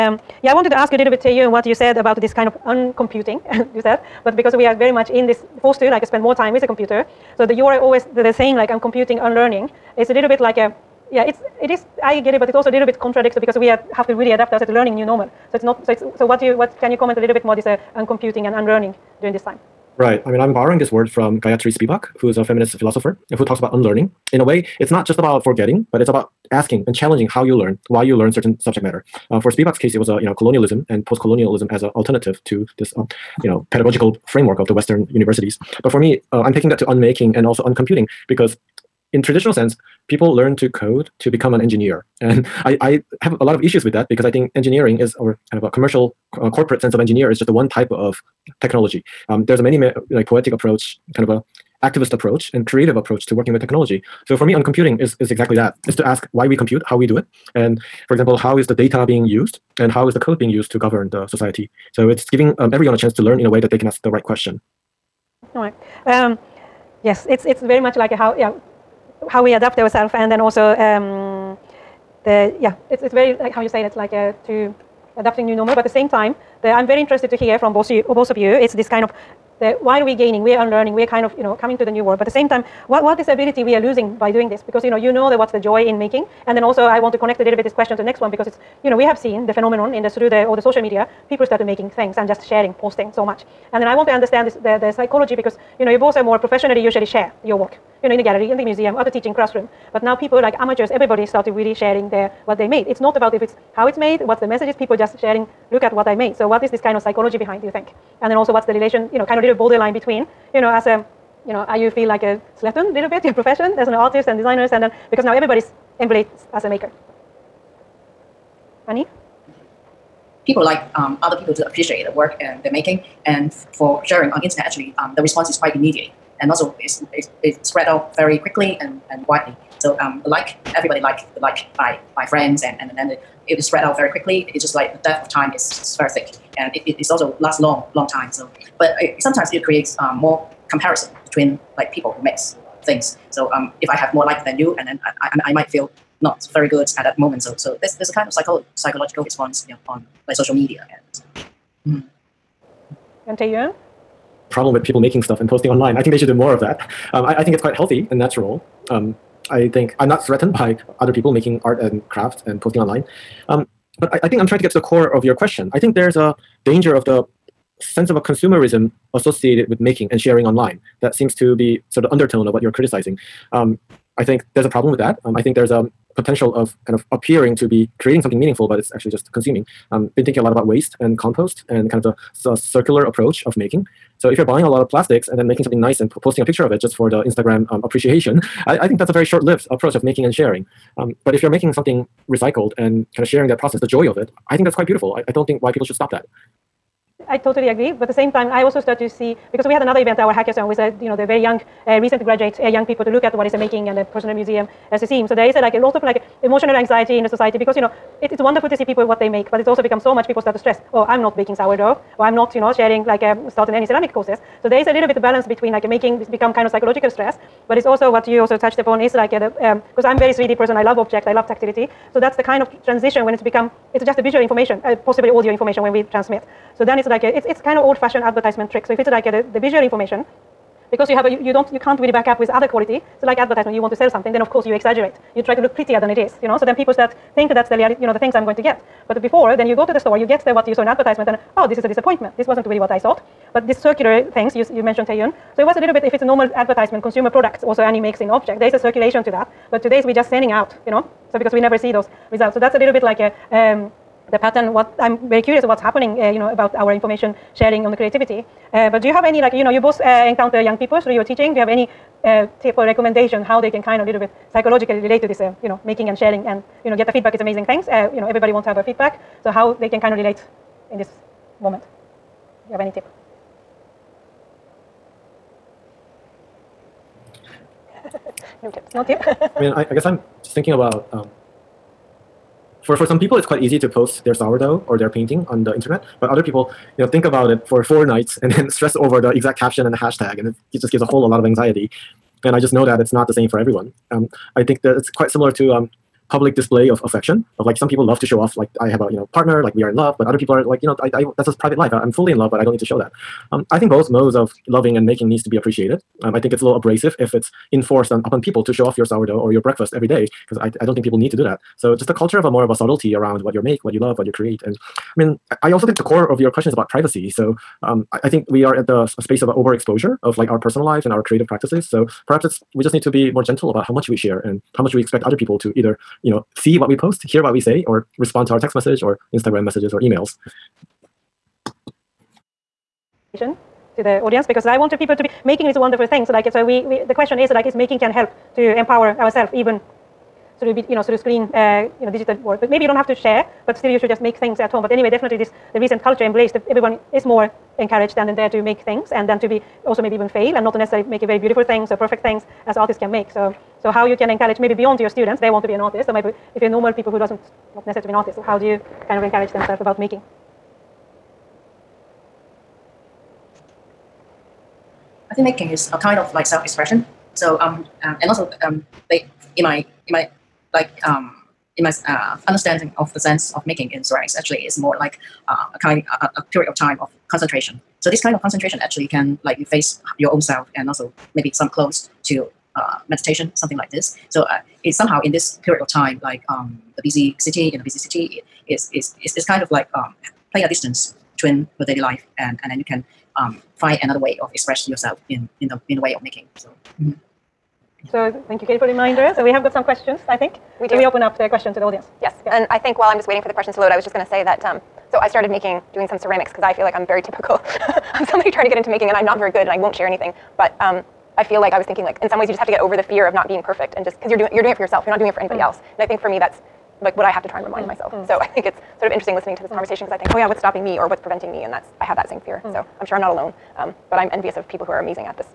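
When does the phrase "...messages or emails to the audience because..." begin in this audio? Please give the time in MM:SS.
05:29.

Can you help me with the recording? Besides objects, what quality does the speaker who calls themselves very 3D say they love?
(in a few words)
tactility.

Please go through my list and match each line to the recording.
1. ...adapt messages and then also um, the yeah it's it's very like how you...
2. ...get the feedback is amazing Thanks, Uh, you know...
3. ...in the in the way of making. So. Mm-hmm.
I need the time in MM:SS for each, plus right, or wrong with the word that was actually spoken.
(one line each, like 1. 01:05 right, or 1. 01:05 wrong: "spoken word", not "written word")
1. 01:09 wrong: "ourselves", not "messages"
2. 04:26 right
3. 06:35 right.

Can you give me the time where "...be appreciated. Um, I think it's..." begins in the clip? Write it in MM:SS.
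05:05.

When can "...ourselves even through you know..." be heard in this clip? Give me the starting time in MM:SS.
05:39.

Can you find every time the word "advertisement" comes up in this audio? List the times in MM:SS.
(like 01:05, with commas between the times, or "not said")
03:48, 03:53, 04:00, 04:06.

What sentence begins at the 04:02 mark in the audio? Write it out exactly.
This wasn't really what I thought.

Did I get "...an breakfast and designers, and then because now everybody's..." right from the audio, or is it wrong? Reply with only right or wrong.
wrong.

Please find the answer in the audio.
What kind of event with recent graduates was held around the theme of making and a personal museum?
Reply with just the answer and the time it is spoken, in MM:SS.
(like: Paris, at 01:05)
hackathon, at 03:20.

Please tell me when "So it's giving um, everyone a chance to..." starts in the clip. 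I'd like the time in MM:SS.
01:01.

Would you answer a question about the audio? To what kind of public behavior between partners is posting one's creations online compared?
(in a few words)
public display of affection.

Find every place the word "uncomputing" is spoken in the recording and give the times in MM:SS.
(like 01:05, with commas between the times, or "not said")
00:02, 00:17, 00:37.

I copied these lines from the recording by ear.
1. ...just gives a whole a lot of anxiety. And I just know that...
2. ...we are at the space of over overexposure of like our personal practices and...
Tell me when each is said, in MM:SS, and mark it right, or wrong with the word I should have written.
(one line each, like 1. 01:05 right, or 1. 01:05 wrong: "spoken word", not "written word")
1. 04:50 right
2. 05:18 wrong: "lives", not "practices".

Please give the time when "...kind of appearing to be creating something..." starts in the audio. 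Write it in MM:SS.
02:56.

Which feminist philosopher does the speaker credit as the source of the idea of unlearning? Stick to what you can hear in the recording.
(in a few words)
Gayatri Spivak.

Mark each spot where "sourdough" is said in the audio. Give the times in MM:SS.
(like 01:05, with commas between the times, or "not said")
03:31, 04:44, 05:09.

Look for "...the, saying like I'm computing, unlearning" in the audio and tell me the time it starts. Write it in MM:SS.
00:08.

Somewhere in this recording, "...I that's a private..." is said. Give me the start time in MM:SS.
05:01.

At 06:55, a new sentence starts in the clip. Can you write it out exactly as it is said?
You're not doing it for anybody mm.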